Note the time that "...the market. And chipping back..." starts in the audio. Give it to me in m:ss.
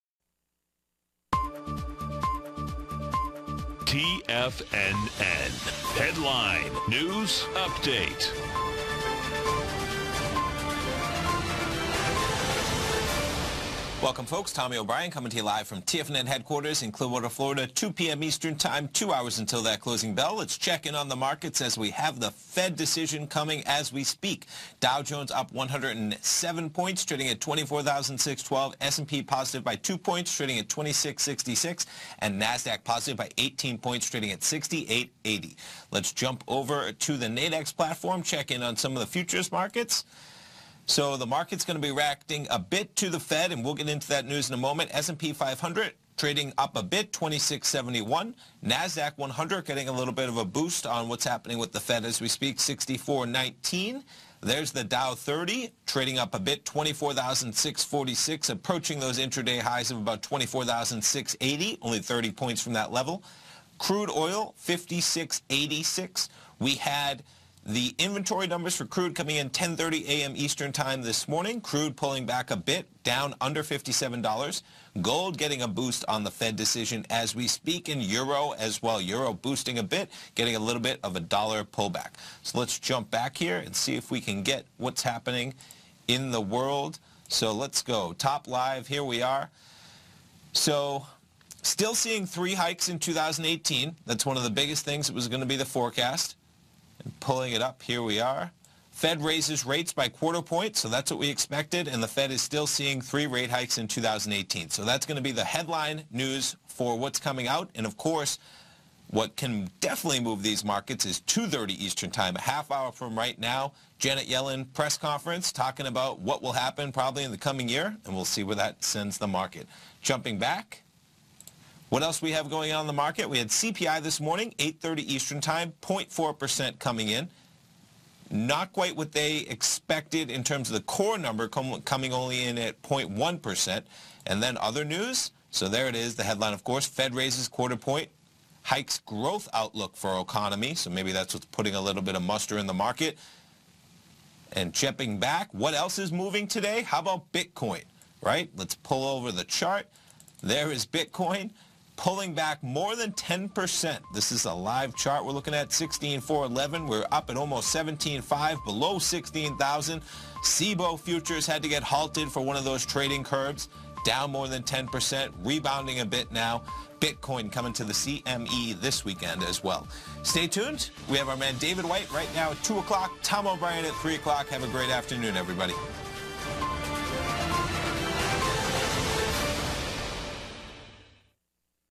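2:22.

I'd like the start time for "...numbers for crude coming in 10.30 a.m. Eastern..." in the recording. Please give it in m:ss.
1:08.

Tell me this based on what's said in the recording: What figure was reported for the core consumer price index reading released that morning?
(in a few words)
0.1%.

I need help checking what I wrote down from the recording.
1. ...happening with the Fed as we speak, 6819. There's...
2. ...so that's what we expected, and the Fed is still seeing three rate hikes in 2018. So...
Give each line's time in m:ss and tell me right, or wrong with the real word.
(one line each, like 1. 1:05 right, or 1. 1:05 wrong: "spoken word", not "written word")
1. 0:51 wrong: "6419", not "6819"
2. 1:40 right.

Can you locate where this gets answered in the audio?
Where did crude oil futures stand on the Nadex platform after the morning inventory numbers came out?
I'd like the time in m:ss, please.
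1:04.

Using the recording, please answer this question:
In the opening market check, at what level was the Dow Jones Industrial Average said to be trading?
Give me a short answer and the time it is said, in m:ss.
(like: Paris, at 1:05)
24,612, at 0:27.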